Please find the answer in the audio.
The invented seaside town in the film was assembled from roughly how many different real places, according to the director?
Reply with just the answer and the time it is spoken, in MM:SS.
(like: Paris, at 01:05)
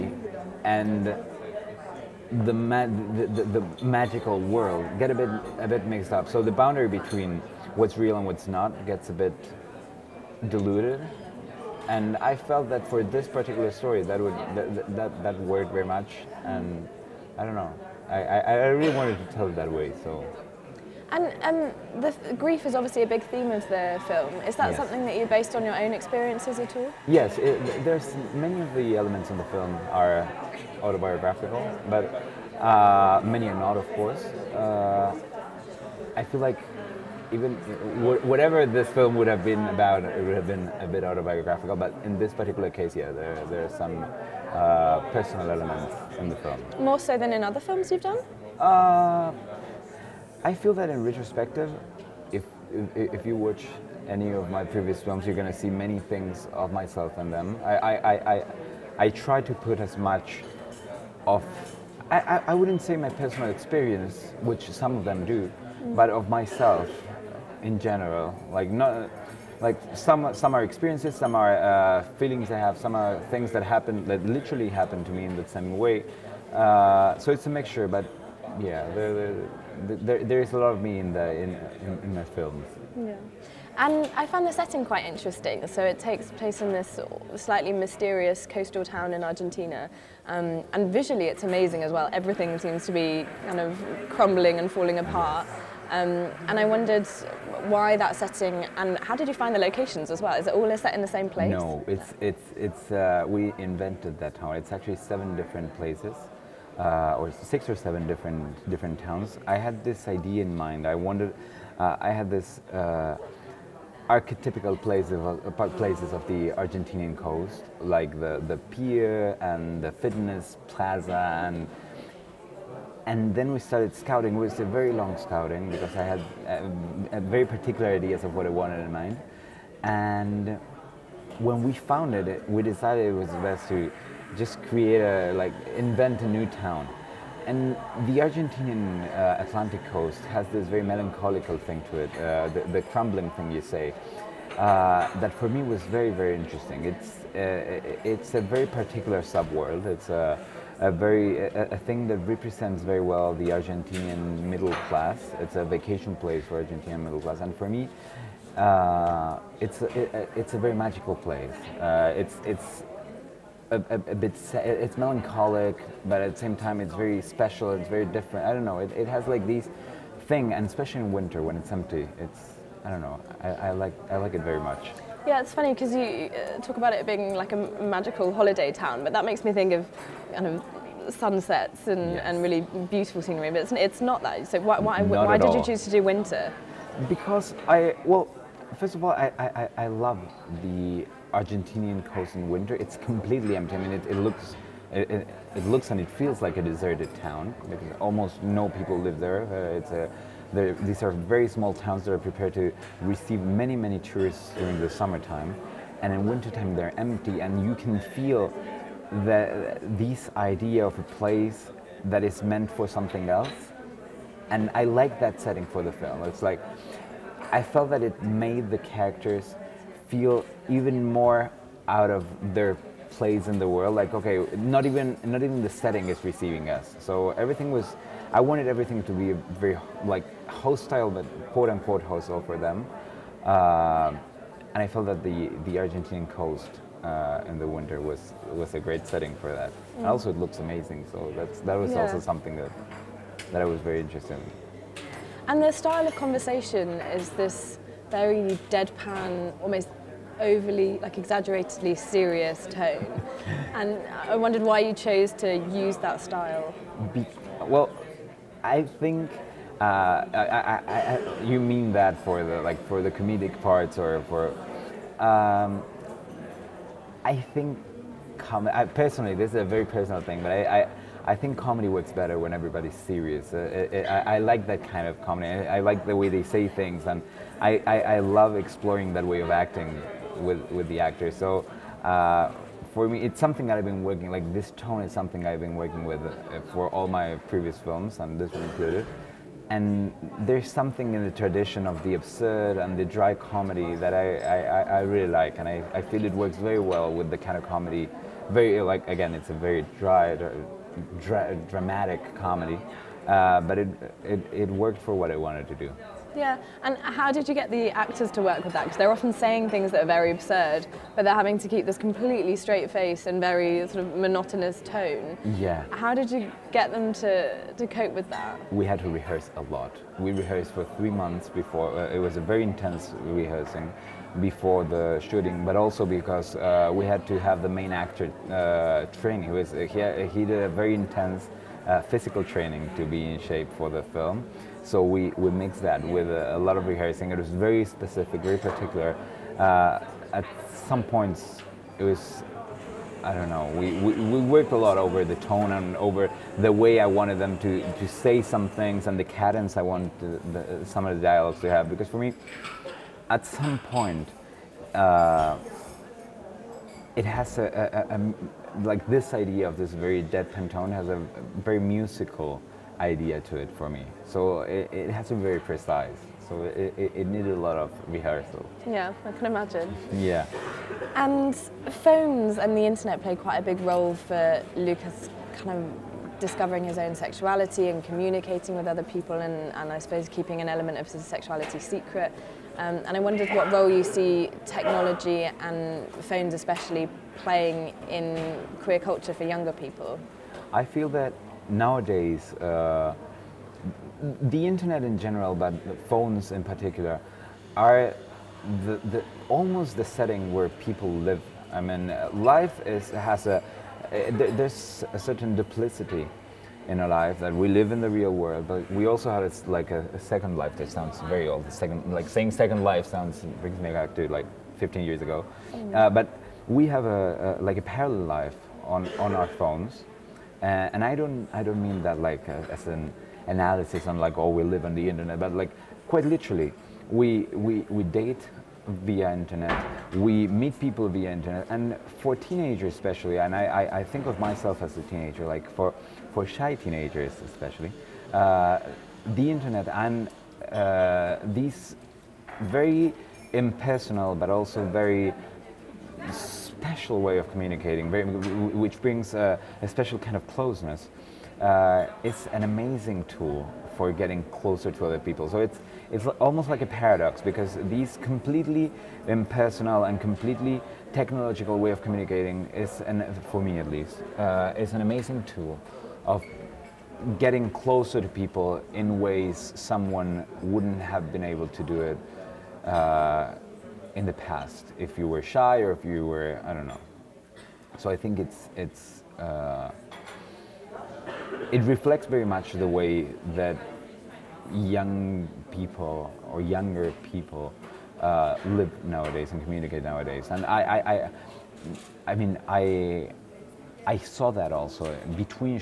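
7, at 01:44.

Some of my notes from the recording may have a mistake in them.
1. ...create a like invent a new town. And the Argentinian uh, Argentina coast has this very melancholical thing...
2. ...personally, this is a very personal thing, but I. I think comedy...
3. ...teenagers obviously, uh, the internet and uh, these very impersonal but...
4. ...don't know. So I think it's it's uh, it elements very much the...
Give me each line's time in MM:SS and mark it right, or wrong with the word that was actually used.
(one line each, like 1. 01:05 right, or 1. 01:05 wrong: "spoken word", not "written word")
1. 02:14 wrong: "Atlantic", not "Argentina"
2. 04:28 right
3. 07:16 wrong: "especially", not "obviously"
4. 07:56 wrong: "reflects", not "elements".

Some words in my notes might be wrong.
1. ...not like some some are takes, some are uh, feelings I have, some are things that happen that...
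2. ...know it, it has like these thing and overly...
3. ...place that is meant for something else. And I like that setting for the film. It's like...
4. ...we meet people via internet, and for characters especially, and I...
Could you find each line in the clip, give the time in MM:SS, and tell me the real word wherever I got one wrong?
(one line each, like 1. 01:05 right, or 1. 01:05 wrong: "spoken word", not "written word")
1. 01:08 wrong: "experiences", not "takes"
2. 02:48 wrong: "especially", not "overly"
3. 03:31 right
4. 07:10 wrong: "teenagers", not "characters".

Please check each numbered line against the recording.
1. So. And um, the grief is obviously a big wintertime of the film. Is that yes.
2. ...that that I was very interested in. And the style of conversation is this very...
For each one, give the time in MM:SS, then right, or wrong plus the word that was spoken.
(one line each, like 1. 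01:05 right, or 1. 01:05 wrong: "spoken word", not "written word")
1. 00:20 wrong: "theme", not "wintertime"
2. 04:02 right.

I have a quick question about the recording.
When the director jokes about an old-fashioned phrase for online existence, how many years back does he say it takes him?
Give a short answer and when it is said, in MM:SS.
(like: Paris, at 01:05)
15 years, at 06:54.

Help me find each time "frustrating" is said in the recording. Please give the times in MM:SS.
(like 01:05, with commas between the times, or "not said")
not said.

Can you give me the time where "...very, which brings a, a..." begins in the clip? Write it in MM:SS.
07:28.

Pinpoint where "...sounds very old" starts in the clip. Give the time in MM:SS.
06:50.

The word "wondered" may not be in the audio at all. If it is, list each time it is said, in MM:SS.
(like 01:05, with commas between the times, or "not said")
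01:36, 04:14, 06:23.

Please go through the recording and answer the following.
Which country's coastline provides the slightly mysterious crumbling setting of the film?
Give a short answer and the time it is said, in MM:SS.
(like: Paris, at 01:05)
Argentina, at 01:29.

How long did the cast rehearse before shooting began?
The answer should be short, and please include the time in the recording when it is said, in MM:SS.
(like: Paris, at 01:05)
3 months, at 05:20.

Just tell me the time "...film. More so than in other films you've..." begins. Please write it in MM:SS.
00:46.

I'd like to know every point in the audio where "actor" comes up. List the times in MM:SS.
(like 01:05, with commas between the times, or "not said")
04:40, 05:07, 05:27.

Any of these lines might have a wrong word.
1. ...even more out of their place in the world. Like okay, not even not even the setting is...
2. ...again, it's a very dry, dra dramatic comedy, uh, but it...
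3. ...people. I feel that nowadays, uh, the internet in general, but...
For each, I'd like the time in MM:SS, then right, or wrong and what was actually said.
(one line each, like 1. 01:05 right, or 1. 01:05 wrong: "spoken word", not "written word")
1. 03:40 right
2. 04:59 right
3. 06:29 right.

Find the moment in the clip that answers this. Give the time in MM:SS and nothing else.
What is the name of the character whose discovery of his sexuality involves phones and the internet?
06:14.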